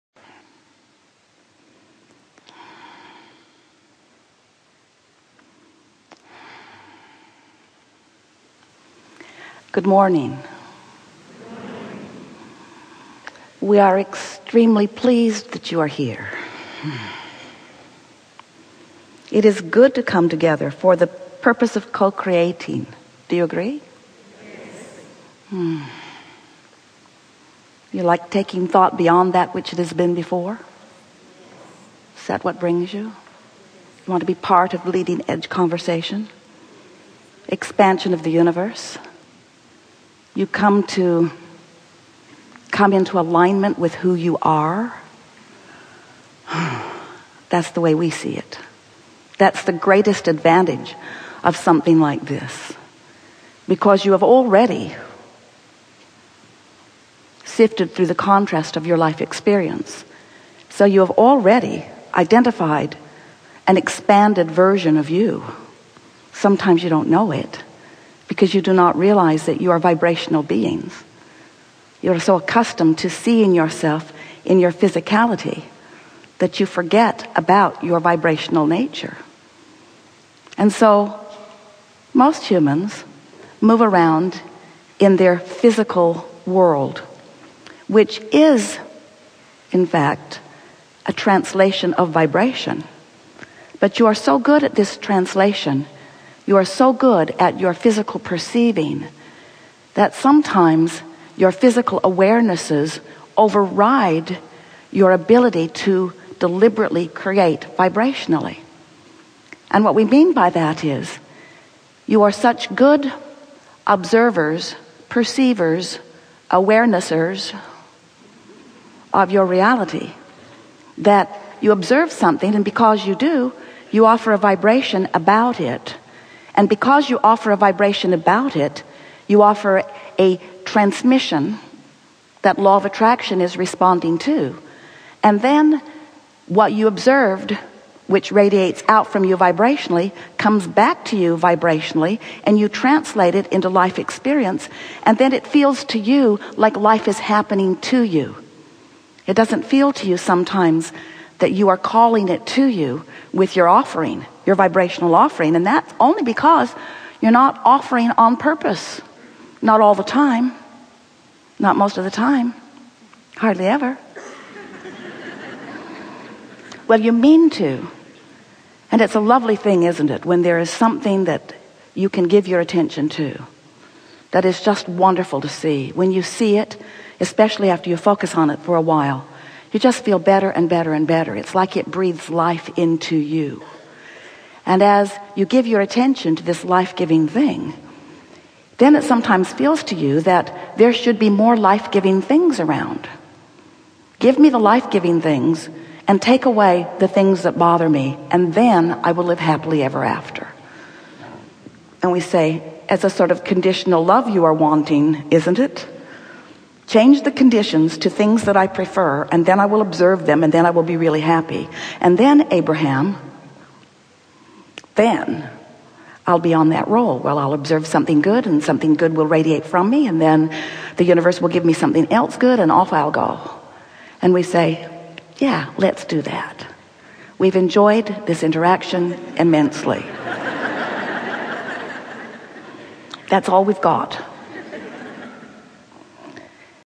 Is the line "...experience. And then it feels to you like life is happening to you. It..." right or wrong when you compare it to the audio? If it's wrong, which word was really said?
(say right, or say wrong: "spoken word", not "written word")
right.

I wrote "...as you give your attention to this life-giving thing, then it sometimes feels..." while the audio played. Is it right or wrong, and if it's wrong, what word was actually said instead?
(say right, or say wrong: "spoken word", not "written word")
right.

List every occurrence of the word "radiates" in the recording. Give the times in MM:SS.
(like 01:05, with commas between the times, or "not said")
02:18, 03:39.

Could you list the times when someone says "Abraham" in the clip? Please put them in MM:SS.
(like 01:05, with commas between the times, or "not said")
03:32.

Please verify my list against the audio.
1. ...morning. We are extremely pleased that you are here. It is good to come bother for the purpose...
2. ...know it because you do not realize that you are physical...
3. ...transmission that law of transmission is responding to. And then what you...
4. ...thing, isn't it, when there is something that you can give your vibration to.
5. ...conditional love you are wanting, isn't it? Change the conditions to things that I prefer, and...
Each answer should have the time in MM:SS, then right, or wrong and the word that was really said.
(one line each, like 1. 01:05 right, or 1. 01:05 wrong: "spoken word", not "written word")
1. 00:09 wrong: "together", not "bother"
2. 01:07 wrong: "vibrational", not "physical"
3. 02:10 wrong: "attraction", not "transmission"
4. 02:49 wrong: "attention", not "vibration"
5. 03:23 right.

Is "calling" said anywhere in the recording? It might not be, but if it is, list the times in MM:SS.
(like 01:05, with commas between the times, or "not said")
02:31.